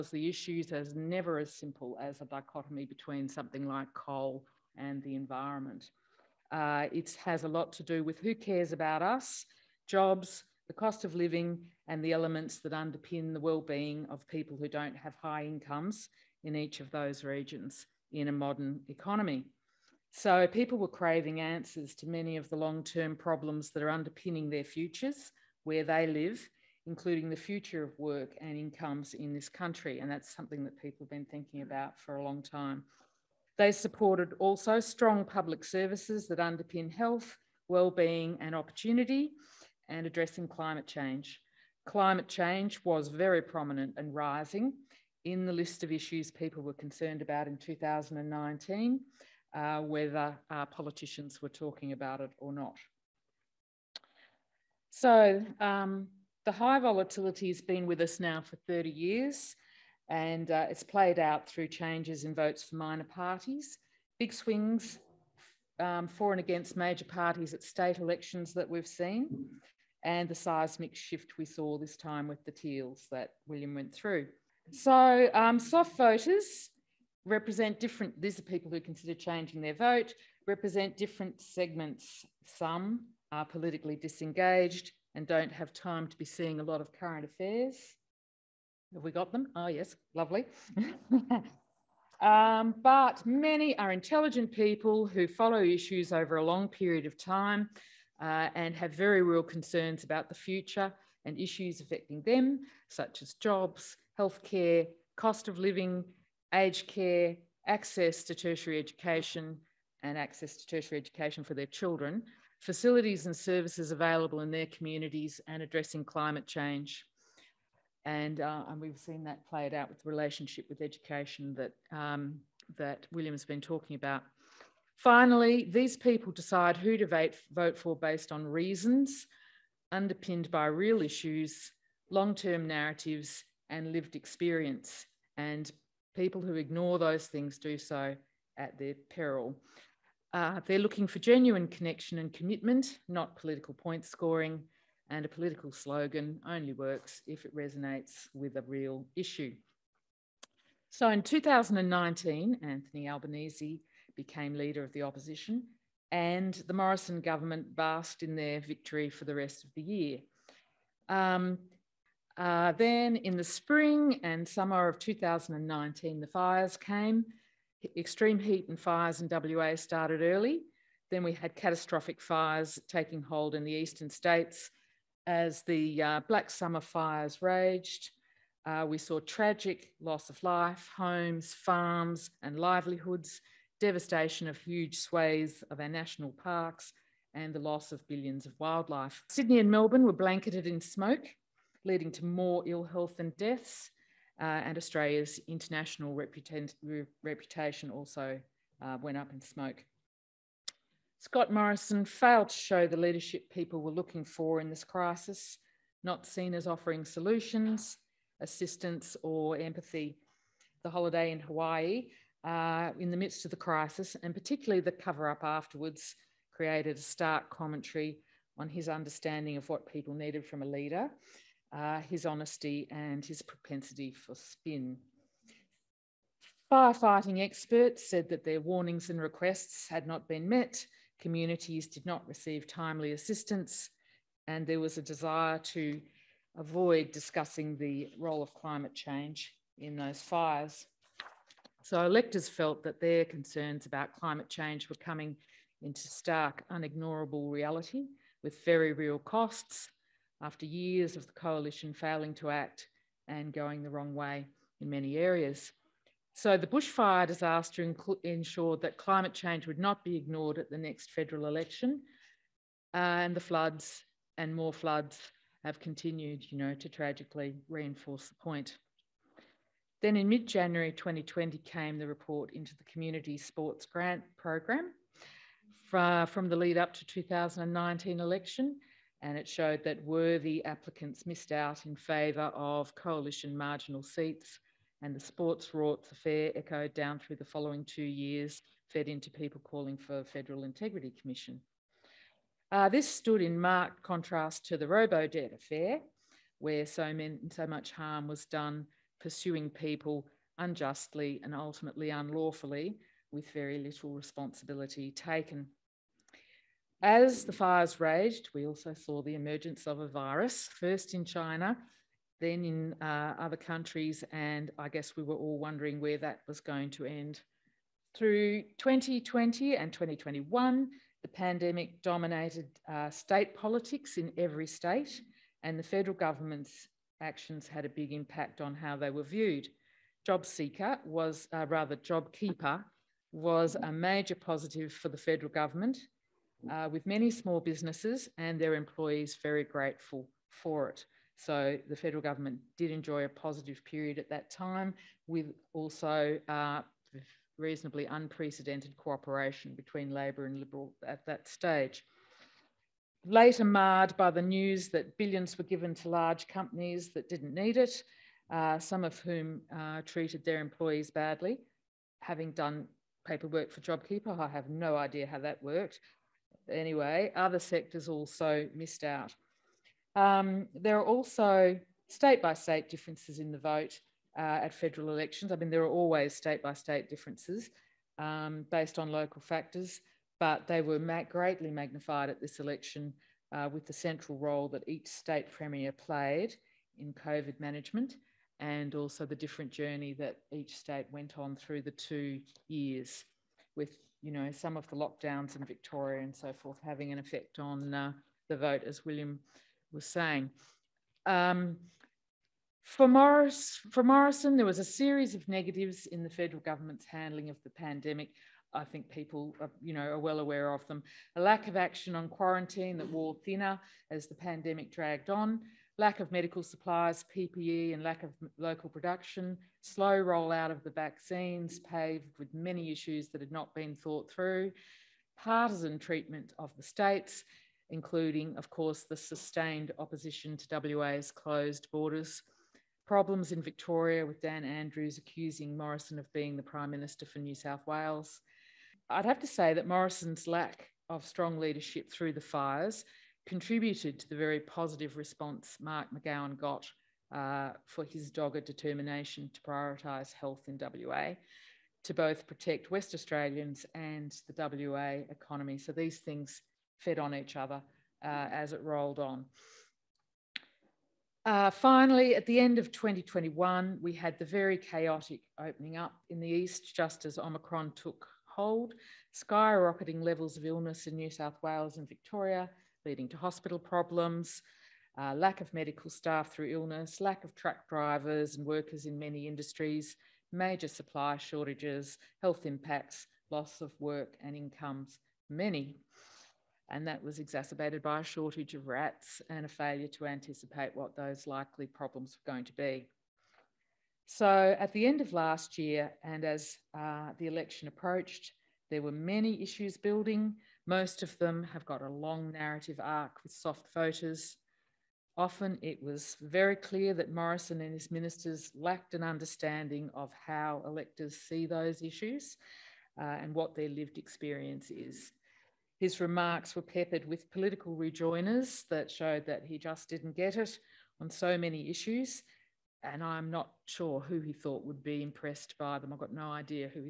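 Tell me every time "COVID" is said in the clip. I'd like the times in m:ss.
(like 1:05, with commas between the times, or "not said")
6:27.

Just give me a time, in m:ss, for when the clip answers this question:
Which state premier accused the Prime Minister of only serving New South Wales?
7:14.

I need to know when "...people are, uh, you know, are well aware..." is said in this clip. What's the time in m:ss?
6:49.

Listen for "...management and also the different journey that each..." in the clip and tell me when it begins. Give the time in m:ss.
6:27.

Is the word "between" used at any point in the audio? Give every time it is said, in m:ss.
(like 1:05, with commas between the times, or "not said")
0:02, 5:49.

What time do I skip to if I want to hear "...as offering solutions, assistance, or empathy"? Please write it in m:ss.
3:26.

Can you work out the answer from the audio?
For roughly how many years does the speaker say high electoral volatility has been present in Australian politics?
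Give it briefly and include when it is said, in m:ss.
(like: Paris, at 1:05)
30 years, at 0:58.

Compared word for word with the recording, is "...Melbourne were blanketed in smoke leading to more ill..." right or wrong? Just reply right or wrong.
right.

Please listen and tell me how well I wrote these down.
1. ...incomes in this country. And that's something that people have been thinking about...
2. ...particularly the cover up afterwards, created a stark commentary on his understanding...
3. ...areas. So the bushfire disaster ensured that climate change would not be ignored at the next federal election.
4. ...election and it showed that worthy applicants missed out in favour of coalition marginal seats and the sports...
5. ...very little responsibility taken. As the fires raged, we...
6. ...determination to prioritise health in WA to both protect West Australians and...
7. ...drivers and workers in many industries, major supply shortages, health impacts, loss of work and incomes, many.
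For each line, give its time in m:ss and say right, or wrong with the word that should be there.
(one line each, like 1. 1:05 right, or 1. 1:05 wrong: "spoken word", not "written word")
1. 0:28 right
2. 3:34 right
3. 4:15 right
4. 4:38 right
5. 5:03 right
6. 7:28 right
7. 7:57 right.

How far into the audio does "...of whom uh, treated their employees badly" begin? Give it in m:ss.
5:59.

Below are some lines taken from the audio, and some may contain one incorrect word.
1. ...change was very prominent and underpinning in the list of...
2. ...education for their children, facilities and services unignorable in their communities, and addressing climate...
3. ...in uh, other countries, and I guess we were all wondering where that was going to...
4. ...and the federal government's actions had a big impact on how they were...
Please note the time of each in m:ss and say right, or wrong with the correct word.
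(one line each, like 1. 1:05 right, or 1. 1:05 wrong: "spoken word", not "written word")
1. 0:42 wrong: "rising", not "underpinning"
2. 1:50 wrong: "available", not "unignorable"
3. 5:12 right
4. 5:25 right.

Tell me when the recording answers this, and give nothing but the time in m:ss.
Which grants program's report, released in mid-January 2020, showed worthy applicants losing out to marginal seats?
4:32.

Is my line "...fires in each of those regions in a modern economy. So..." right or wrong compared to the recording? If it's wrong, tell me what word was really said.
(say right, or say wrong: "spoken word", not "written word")
wrong: "incomes", not "fires".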